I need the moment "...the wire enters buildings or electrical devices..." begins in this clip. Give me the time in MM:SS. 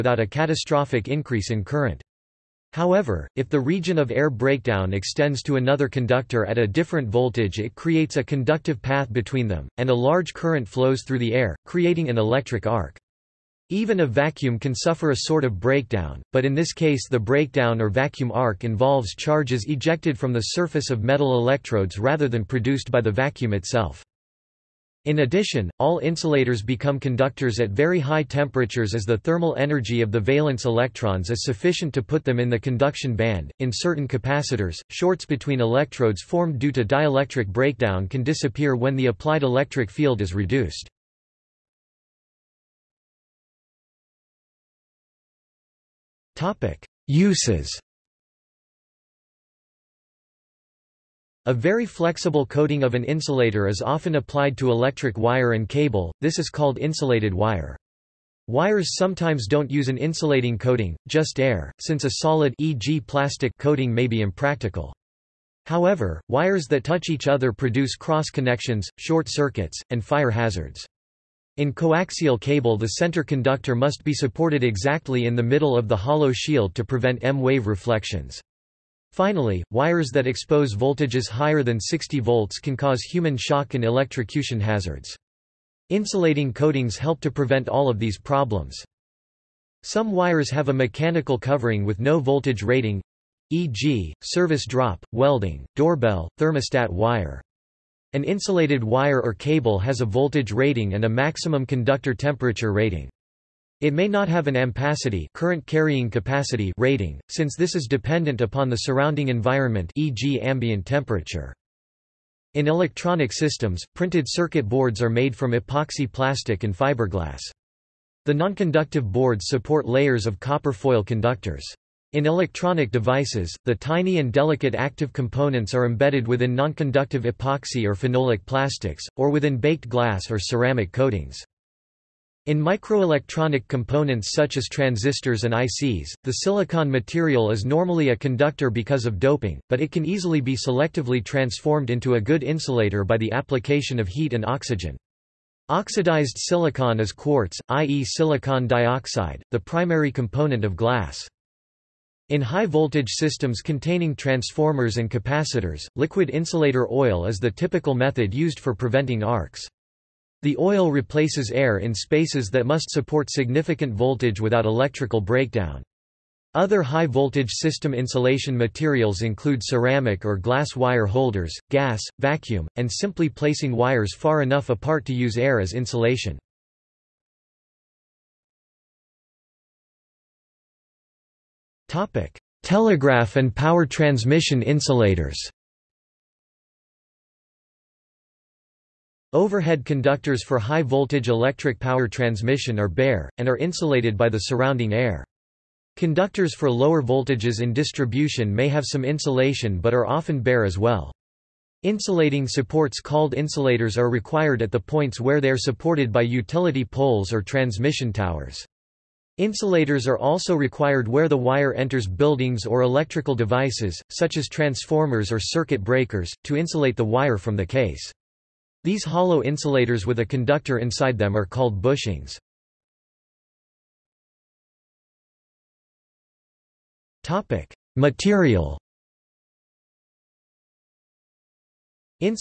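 03:31.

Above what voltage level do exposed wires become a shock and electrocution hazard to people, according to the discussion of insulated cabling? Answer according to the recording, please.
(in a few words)
60 volts.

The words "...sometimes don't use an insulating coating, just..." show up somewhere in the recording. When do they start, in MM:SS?
00:58.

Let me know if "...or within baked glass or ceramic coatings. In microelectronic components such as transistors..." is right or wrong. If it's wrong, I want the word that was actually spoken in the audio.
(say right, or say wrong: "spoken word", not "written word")
right.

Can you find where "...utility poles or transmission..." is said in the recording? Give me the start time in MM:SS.
03:26.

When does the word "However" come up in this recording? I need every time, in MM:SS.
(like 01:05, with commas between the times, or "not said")
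00:02, 01:05.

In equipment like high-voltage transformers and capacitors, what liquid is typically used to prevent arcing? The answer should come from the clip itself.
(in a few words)
Insulator oil.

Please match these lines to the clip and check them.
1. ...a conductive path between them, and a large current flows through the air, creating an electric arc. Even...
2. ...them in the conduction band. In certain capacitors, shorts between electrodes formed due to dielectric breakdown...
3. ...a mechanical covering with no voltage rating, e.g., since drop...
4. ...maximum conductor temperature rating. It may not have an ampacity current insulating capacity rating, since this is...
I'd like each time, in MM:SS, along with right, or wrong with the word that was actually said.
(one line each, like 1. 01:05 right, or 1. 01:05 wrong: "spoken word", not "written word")
1. 00:08 right
2. 00:32 right
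3. 01:30 wrong: "service", not "since"
4. 01:41 wrong: "carrying", not "insulating".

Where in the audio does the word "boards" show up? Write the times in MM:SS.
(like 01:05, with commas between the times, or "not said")
01:54, 01:59.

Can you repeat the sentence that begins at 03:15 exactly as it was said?
Conductors for lower voltages in distribution may have some insulation but are often bare as well.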